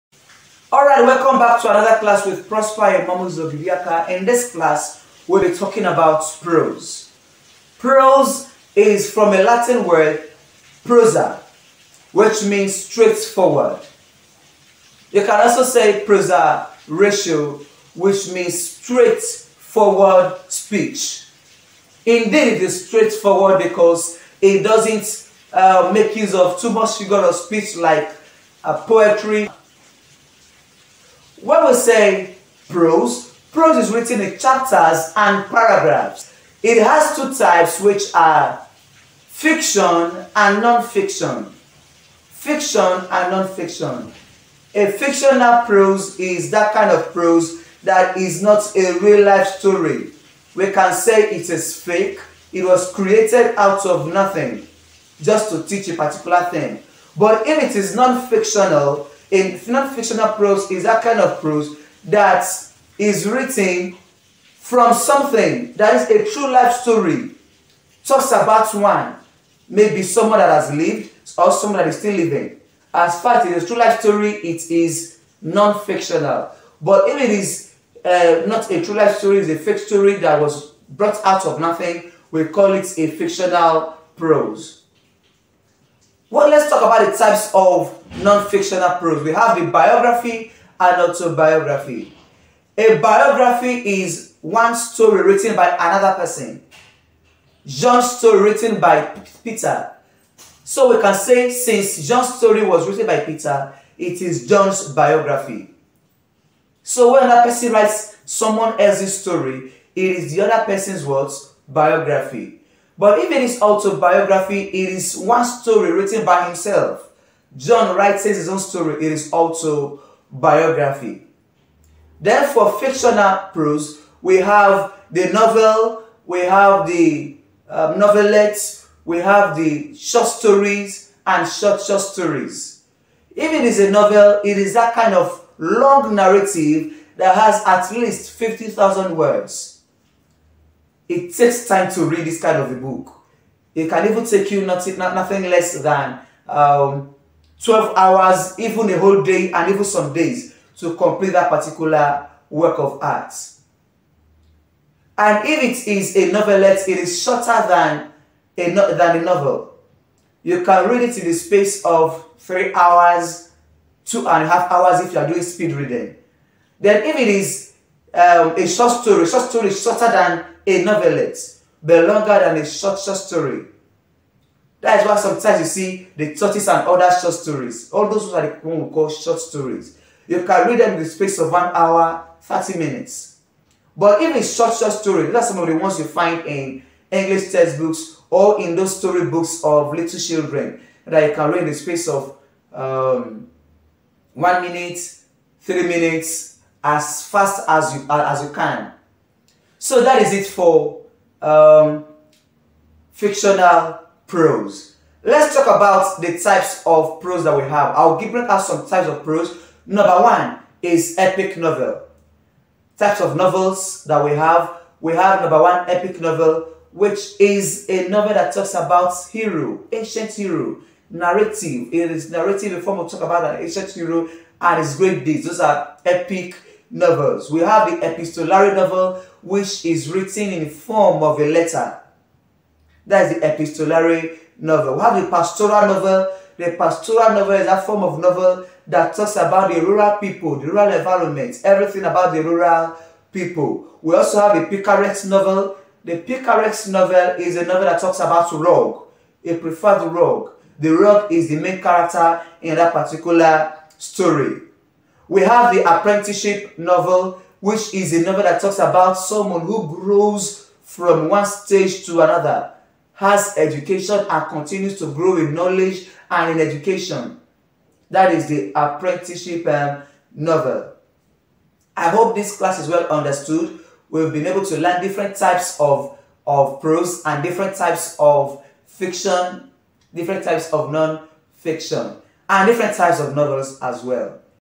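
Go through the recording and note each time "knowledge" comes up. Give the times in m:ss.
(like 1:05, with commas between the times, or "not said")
4:25.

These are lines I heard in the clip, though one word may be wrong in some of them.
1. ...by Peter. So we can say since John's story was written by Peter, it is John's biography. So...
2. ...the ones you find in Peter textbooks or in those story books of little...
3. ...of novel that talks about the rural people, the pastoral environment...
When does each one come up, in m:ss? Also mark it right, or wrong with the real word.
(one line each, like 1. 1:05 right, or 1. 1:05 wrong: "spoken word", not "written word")
1. 1:38 right
2. 3:05 wrong: "English", not "Peter"
3. 3:58 wrong: "rural", not "pastoral".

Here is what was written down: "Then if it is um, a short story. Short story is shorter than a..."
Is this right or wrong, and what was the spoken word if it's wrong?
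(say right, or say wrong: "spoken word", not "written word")
right.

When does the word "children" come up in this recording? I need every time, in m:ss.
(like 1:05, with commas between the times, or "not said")
3:10.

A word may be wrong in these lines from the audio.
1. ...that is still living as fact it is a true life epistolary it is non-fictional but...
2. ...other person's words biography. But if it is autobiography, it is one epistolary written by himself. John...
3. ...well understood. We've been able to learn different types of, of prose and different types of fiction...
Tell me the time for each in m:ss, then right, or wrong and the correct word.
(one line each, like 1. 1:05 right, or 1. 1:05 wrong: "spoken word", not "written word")
1. 1:11 wrong: "story", not "epistolary"
2. 1:50 wrong: "story", not "epistolary"
3. 4:32 right.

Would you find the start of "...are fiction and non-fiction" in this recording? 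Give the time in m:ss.
0:38.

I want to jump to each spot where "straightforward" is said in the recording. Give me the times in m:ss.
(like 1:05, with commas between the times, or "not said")
0:12, 0:18, 0:22.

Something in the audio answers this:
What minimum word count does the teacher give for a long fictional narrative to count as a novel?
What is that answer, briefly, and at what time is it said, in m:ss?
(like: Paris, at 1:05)
50,000 words, at 2:18.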